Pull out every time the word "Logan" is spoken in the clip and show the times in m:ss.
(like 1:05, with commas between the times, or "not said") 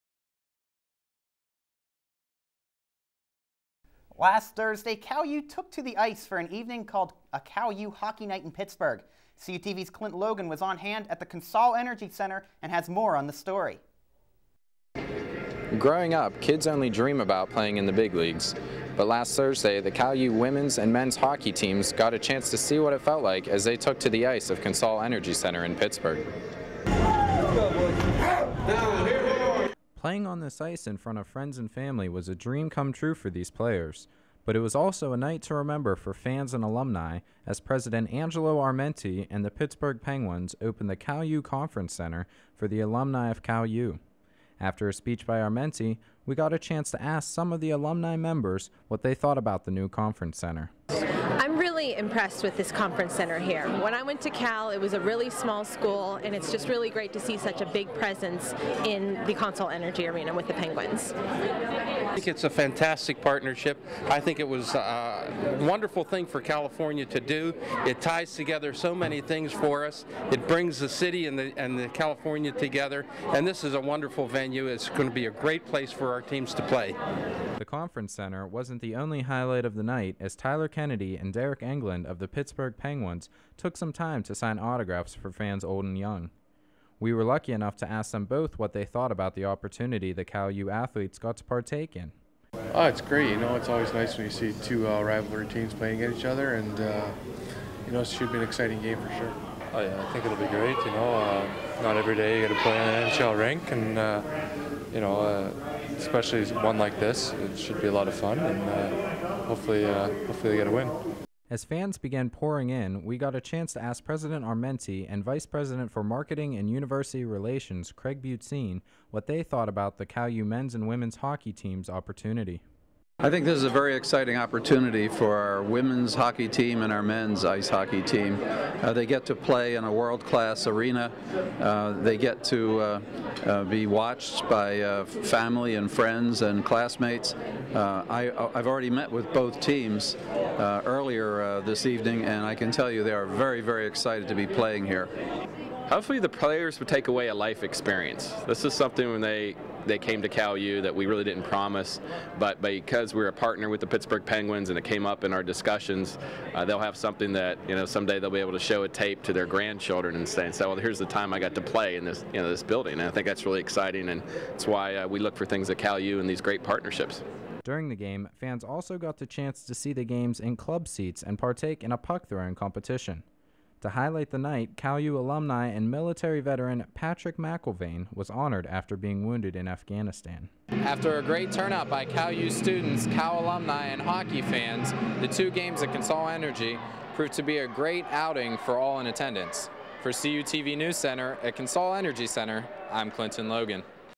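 0:10, 3:13.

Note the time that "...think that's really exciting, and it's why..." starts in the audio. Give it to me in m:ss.
2:43.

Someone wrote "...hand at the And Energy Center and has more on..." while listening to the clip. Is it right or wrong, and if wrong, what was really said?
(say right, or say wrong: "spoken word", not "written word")
wrong: "Consol", not "And".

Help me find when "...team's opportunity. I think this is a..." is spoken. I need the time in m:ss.
2:01.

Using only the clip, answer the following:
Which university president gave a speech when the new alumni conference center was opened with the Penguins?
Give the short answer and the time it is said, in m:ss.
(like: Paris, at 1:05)
Angelo Armenti, at 0:38.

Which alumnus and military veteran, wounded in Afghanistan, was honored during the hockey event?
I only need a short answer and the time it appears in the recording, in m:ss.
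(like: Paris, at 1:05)
Patrick McIlvain, at 2:56.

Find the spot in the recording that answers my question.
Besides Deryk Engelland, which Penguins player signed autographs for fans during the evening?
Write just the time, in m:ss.
1:20.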